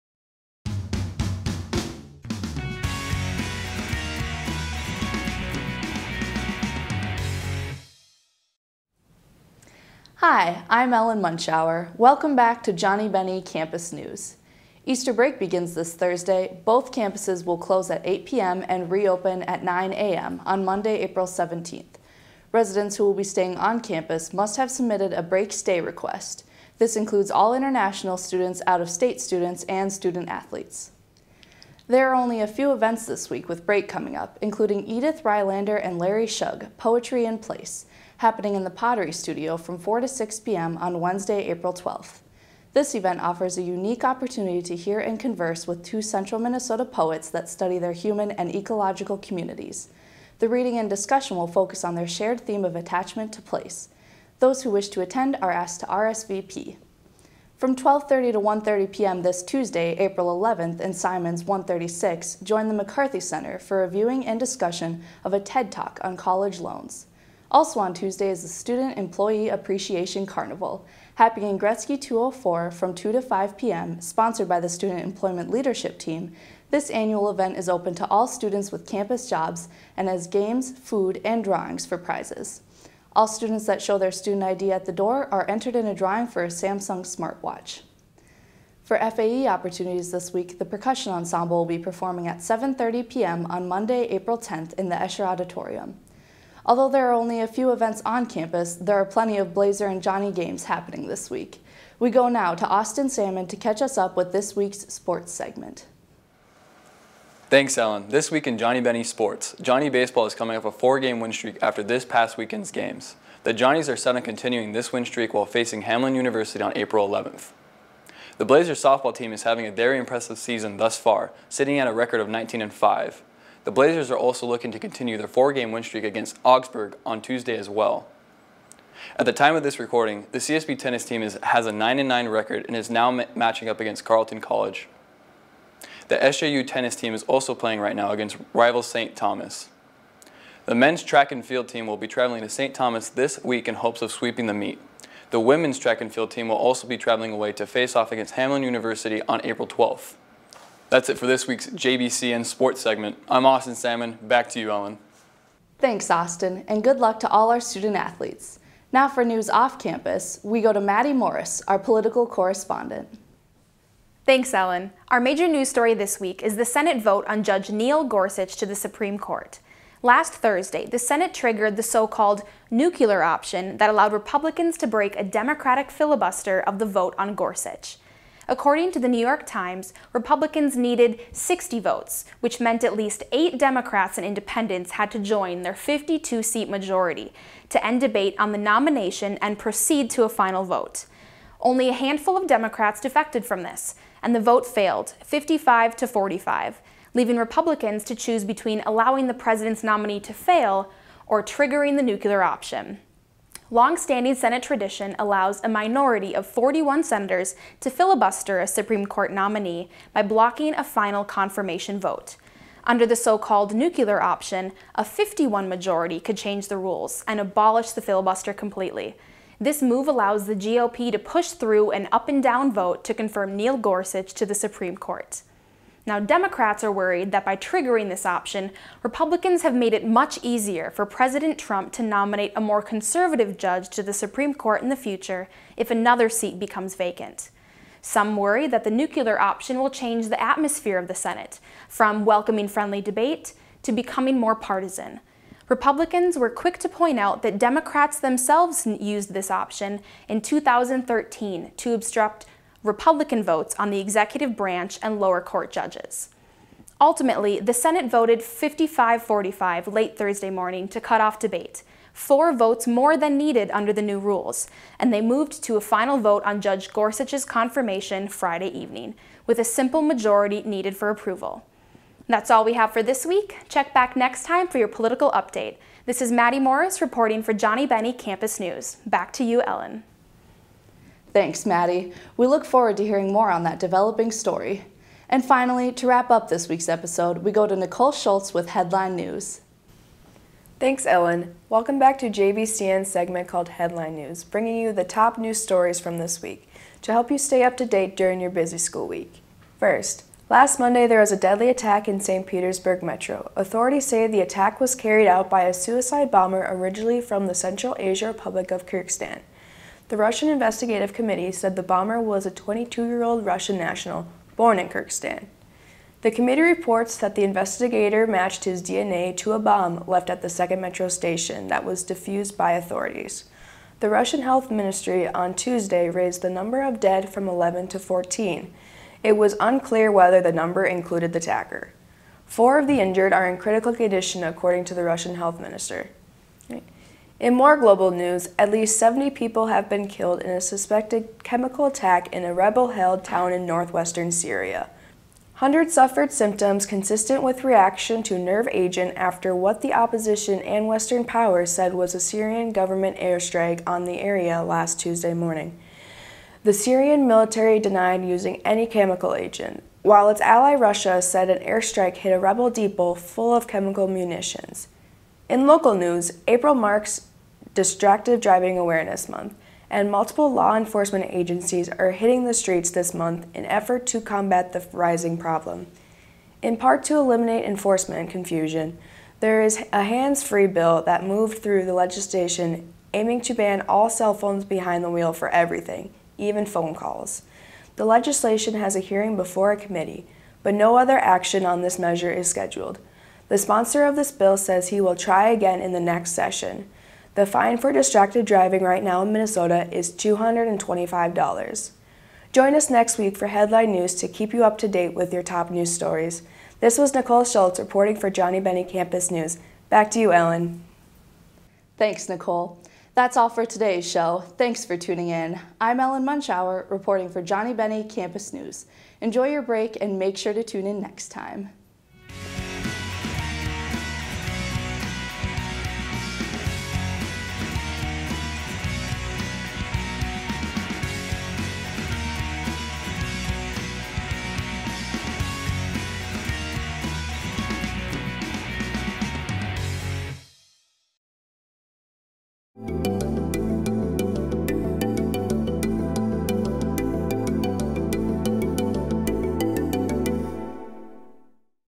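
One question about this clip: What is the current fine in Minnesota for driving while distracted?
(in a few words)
$225.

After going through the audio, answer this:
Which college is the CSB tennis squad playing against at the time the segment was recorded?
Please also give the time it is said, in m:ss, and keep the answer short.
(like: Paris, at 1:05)
Carleton College, at 2:14.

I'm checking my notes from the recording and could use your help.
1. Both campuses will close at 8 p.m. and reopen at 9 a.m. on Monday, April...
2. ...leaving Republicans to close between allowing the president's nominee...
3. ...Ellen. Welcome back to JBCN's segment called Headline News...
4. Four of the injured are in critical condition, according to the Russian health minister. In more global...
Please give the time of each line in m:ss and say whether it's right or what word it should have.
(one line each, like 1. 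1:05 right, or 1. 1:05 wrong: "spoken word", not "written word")
1. 0:16 right
2. 3:17 wrong: "choose", not "close"
3. 4:51 right
4. 5:32 right.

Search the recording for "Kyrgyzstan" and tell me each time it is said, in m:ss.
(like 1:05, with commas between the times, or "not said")
5:08, 5:14.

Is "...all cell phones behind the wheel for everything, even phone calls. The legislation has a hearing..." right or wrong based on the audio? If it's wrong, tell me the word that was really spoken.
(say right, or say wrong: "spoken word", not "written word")
right.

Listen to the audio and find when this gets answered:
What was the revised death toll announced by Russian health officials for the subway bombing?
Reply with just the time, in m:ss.
5:27.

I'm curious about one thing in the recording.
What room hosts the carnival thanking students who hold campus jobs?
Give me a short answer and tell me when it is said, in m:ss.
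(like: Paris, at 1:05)
Gorecki 204, at 1:11.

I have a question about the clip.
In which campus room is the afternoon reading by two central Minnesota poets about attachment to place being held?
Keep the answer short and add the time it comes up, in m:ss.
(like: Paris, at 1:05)
Pottery Studio, at 0:38.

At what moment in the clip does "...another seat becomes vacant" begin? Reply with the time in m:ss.
3:55.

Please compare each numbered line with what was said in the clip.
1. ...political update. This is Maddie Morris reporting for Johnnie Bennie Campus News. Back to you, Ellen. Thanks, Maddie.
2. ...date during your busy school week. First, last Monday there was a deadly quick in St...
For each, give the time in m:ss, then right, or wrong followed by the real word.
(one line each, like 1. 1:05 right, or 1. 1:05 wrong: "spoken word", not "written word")
1. 4:34 right
2. 4:57 wrong: "attack", not "quick".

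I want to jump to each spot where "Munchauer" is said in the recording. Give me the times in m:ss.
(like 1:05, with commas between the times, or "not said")
0:11, 6:56.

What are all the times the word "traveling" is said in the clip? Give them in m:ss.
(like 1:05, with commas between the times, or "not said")
2:22, 2:26.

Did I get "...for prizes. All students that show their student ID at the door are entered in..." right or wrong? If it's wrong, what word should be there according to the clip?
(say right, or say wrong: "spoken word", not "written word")
right.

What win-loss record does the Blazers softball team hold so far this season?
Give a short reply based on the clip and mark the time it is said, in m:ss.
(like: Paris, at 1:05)
19-5, at 2:02.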